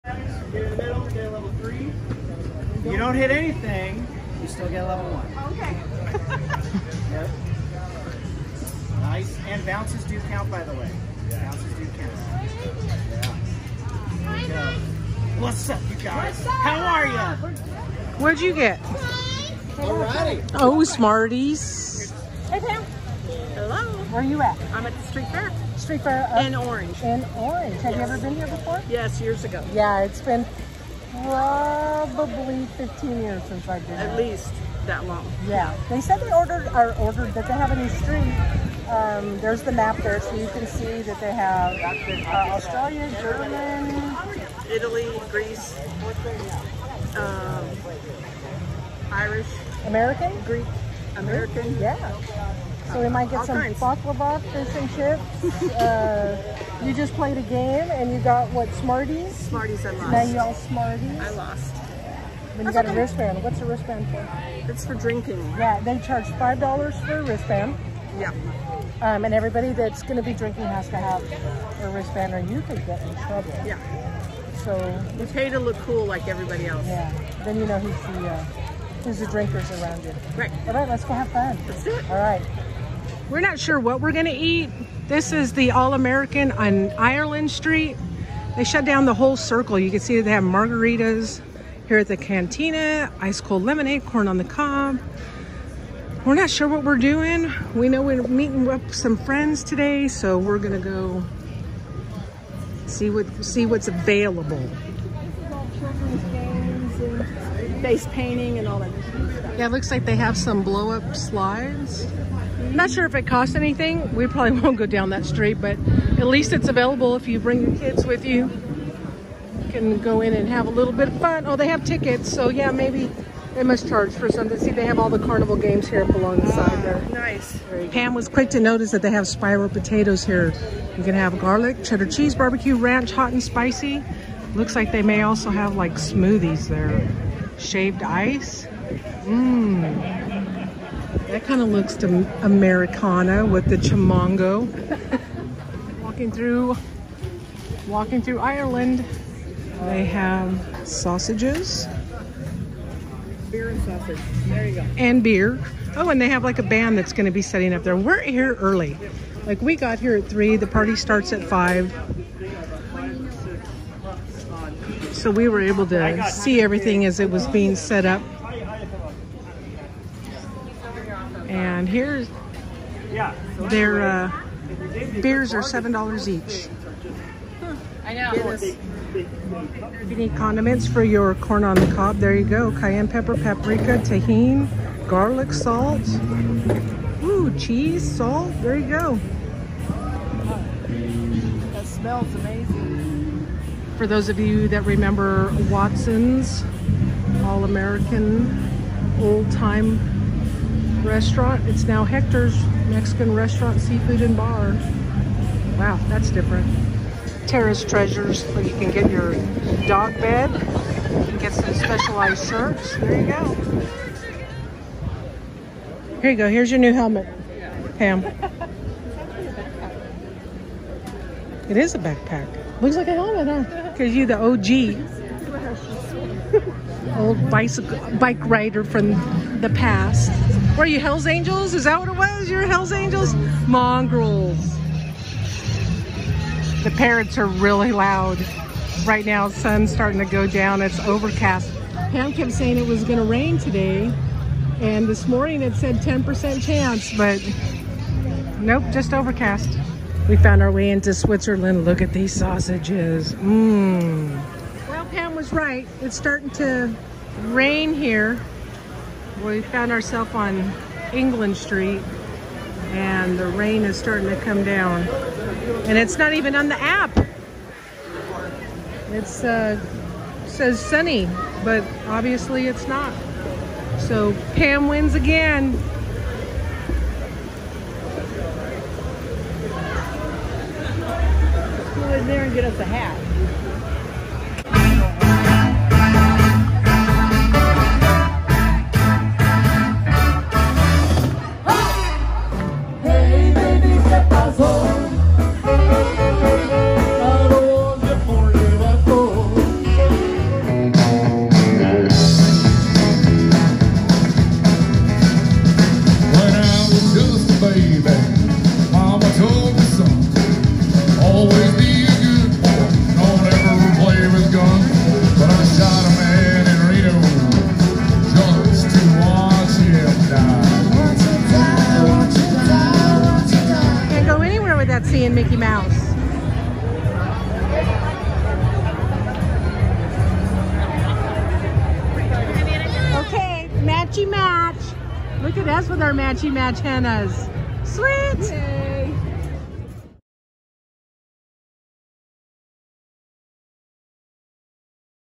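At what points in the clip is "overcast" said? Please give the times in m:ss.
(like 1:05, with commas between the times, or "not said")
4:01, 4:09.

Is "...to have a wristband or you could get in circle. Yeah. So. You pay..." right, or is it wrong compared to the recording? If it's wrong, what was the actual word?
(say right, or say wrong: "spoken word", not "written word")
wrong: "trouble", not "circle".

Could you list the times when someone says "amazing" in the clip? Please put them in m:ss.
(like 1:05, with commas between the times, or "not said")
3:12.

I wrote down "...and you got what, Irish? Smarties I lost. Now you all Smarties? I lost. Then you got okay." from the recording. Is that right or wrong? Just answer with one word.
wrong.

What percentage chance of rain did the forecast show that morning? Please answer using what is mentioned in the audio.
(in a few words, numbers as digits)
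10%.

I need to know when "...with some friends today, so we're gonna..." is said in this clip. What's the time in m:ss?
1:38.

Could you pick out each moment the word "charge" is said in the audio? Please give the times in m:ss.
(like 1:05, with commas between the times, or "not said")
1:05, 2:03.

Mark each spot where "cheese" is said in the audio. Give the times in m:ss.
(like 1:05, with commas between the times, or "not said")
2:12, 3:07.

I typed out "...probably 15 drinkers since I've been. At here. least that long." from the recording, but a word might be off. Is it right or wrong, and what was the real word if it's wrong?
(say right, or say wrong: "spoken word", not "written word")
wrong: "years", not "drinkers".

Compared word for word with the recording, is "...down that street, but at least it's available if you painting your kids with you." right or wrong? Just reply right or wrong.
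wrong.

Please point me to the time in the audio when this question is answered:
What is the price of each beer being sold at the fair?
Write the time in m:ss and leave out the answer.
2:55.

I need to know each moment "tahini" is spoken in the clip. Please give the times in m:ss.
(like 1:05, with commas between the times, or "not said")
3:03.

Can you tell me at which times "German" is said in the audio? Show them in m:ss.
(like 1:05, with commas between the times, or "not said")
0:43.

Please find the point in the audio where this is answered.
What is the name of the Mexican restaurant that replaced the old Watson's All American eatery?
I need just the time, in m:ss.
3:22.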